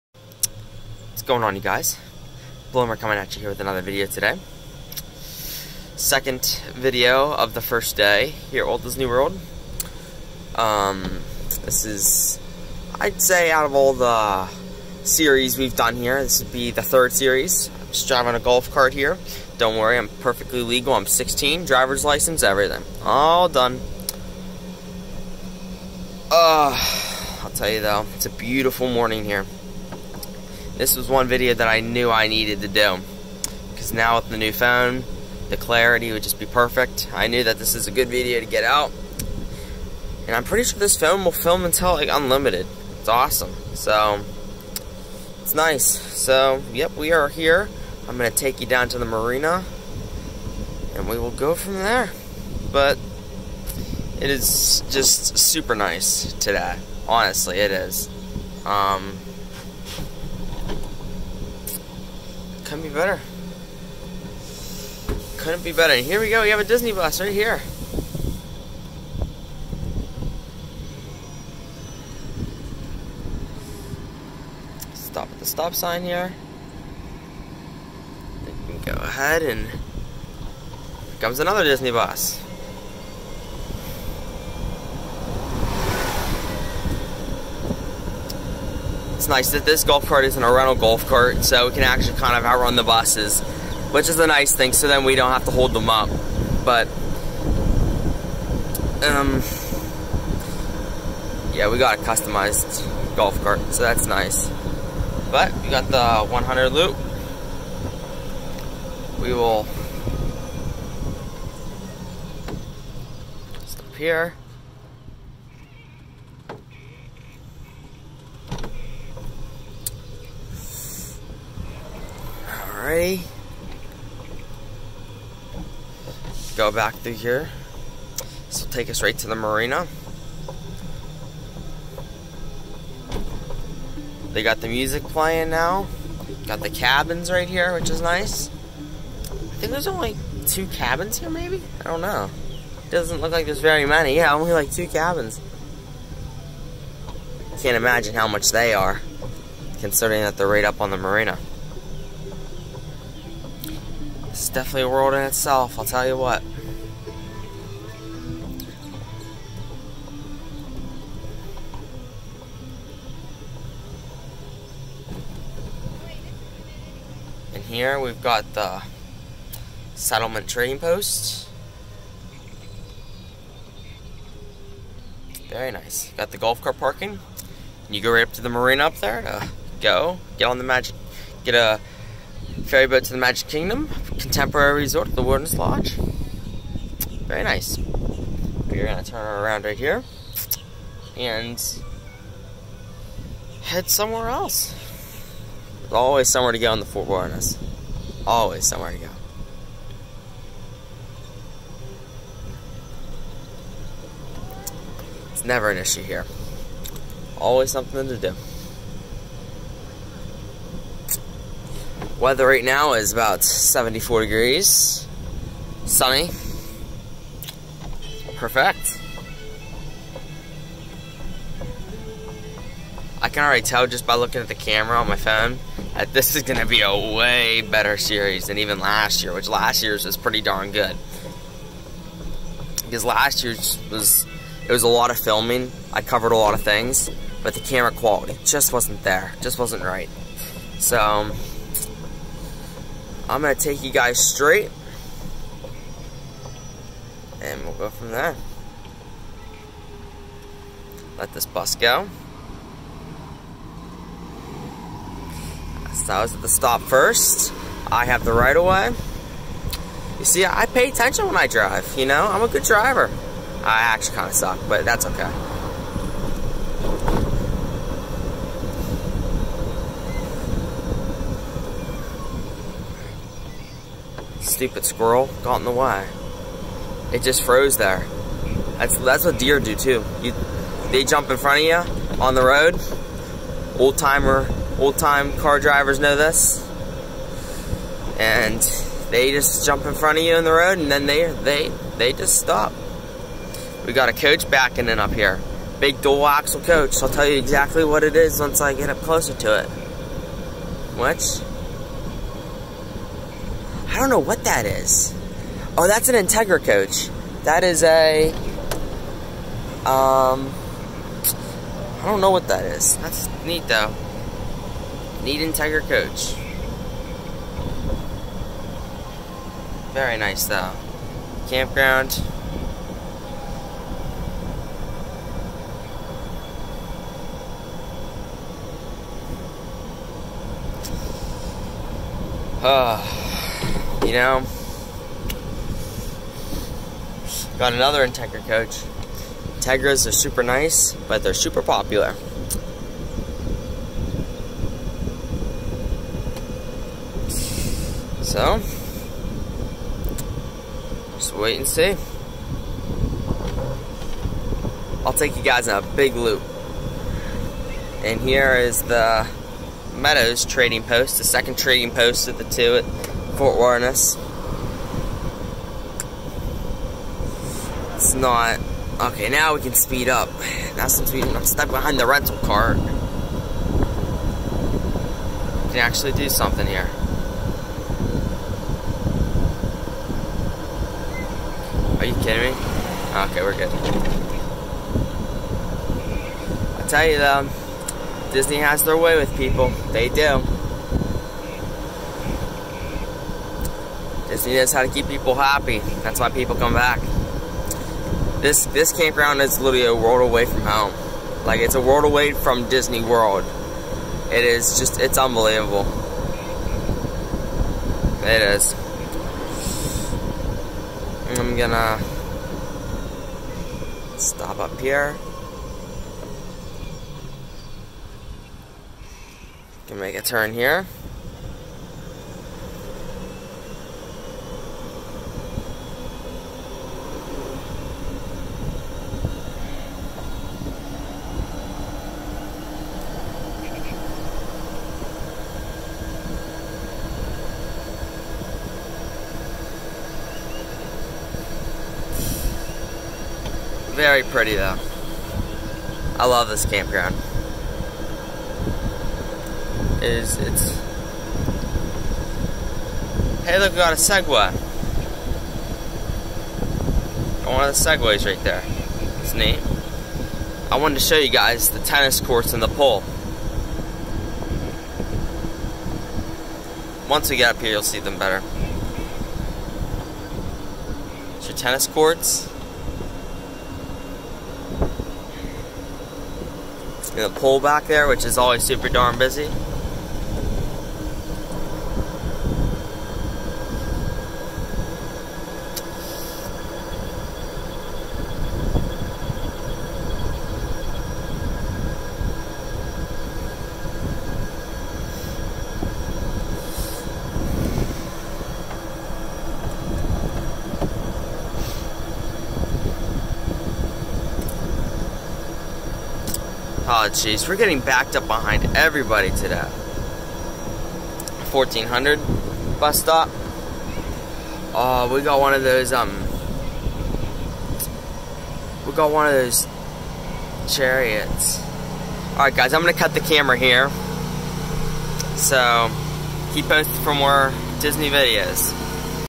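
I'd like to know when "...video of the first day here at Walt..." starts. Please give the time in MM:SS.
00:06.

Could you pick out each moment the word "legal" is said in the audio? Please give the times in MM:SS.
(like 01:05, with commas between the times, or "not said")
00:20.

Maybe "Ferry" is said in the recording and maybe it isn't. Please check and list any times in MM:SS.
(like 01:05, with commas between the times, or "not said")
03:02.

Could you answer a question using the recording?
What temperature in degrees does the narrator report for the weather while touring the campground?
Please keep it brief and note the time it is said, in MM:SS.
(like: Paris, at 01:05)
74, at 03:33.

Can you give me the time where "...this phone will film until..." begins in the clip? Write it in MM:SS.
00:40.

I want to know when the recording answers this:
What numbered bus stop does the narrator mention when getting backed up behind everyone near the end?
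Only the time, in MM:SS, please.
08:31.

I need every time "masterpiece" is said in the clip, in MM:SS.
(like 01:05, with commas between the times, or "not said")
not said.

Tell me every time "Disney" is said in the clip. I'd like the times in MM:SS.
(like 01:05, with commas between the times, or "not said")
00:08, 01:06, 01:21, 06:28, 06:42, 08:47.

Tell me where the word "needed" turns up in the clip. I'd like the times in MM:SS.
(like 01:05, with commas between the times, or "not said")
00:32.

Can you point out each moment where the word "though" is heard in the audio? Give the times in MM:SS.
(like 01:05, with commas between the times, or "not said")
00:27, 05:13, 05:20, 06:27, 07:24.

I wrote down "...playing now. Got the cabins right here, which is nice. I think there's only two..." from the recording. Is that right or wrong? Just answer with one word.
right.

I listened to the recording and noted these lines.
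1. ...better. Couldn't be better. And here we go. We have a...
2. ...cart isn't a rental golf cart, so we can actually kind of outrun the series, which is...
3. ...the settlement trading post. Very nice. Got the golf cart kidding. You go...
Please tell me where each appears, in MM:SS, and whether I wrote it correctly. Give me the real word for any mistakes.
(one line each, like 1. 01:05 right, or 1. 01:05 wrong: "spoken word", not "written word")
1. 01:02 right
2. 01:30 wrong: "buses", not "series"
3. 02:48 wrong: "parking", not "kidding".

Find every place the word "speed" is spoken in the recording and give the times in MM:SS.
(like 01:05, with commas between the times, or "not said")
06:09.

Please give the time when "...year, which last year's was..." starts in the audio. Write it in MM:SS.
03:49.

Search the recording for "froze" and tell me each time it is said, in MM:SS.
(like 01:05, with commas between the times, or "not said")
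04:37.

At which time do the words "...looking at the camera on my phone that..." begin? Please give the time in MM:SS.
03:44.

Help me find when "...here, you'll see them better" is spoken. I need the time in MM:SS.
07:47.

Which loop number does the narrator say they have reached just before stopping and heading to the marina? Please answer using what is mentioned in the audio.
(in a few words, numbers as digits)
100.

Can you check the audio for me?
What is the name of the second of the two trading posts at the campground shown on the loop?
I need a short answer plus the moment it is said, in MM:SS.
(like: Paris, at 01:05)
Meadows trading post, at 05:59.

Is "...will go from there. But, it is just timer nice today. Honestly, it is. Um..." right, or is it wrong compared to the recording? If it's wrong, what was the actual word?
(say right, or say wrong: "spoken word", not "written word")
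wrong: "super", not "timer".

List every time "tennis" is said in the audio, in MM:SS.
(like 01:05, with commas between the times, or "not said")
07:41, 07:51.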